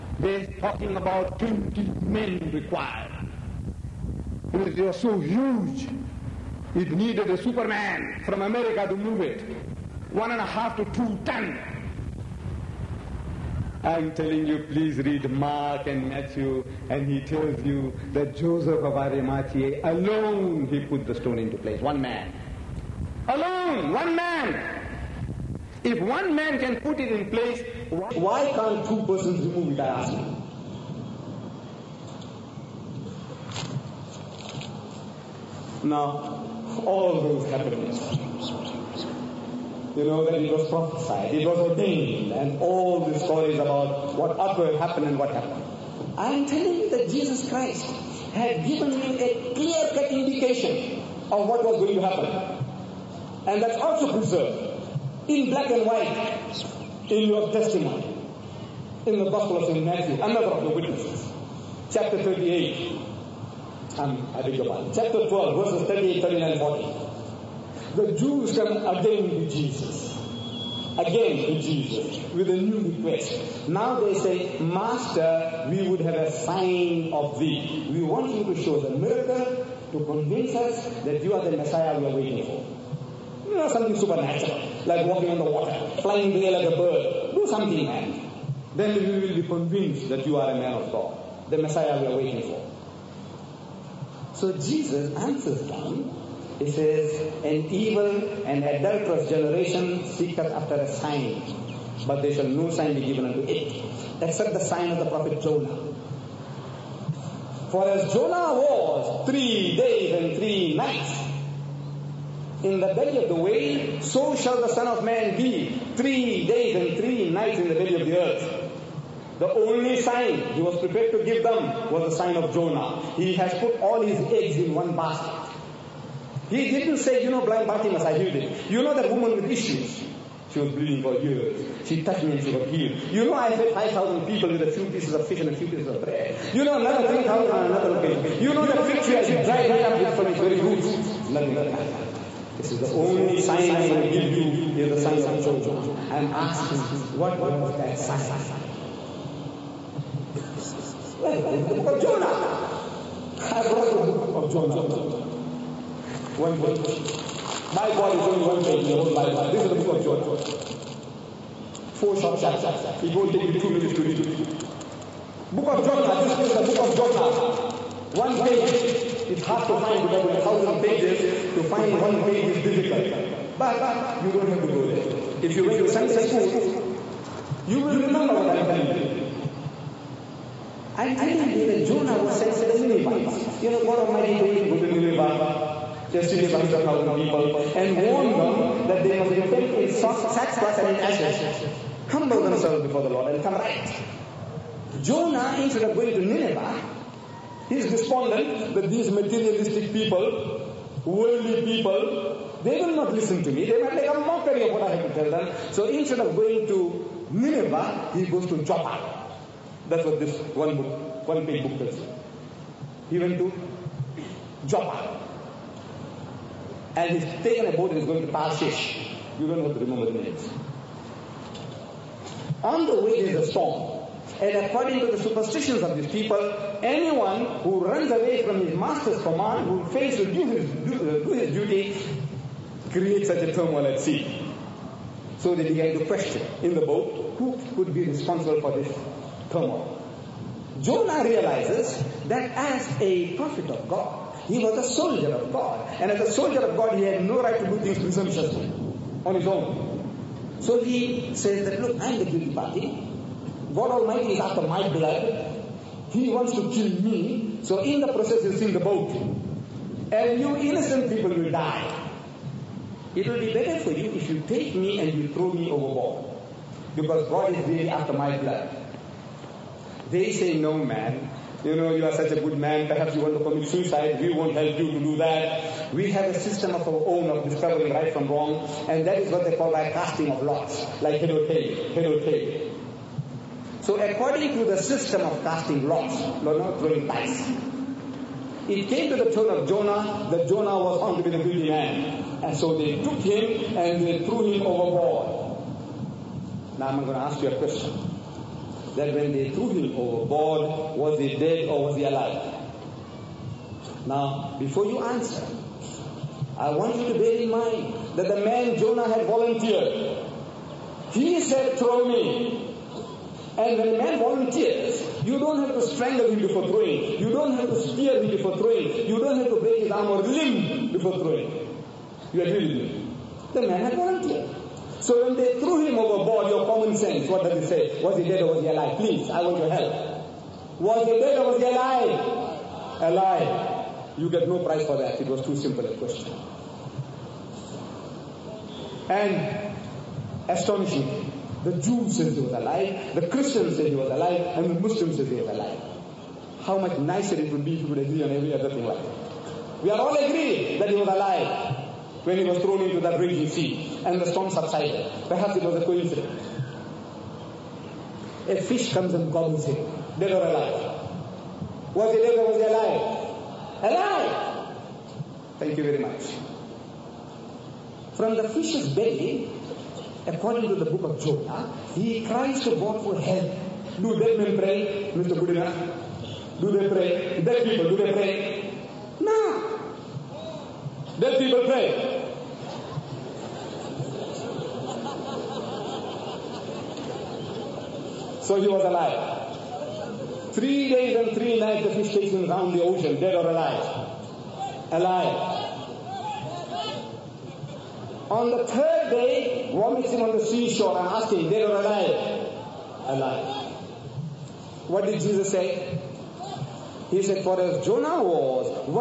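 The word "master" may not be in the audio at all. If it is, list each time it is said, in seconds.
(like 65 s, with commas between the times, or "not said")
74 s, 228 s.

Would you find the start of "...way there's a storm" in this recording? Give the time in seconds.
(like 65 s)
223 s.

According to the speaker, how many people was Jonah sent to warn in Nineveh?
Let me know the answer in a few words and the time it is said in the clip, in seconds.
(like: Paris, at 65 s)
100,000, at 186 s.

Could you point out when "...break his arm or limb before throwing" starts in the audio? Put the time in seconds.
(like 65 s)
319 s.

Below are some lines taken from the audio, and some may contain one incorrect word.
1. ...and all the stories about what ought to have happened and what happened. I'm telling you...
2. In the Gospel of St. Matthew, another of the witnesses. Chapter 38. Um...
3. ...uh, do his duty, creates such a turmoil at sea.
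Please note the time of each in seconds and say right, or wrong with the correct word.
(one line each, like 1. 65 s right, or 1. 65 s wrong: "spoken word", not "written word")
1. 42 s right
2. 59 s right
3. 231 s right.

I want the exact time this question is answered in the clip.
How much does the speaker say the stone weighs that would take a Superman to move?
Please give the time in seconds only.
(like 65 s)
10 s.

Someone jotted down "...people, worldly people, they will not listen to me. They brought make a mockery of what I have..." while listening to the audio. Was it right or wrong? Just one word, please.
wrong.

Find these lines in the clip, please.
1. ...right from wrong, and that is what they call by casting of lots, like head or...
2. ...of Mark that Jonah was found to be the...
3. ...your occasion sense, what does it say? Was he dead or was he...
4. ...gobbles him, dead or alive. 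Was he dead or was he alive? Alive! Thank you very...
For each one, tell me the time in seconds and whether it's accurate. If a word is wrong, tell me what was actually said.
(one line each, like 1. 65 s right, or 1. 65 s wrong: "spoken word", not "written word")
1. 277 s right
2. 289 s wrong: "Jonah", not "Mark"
3. 326 s wrong: "common", not "occasion"
4. 359 s right.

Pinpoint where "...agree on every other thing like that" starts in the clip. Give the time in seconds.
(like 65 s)
347 s.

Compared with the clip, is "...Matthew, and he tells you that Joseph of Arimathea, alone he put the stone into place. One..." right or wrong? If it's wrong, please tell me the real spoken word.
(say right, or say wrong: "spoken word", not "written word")
right.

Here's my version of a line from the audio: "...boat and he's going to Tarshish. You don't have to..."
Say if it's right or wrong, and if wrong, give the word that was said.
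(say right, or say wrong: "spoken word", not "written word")
right.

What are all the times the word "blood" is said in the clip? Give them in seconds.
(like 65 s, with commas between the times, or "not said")
254 s, 268 s.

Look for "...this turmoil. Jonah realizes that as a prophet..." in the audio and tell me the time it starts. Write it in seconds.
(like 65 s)
238 s.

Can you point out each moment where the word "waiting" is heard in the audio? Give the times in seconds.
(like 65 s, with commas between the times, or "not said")
82 s, 92 s.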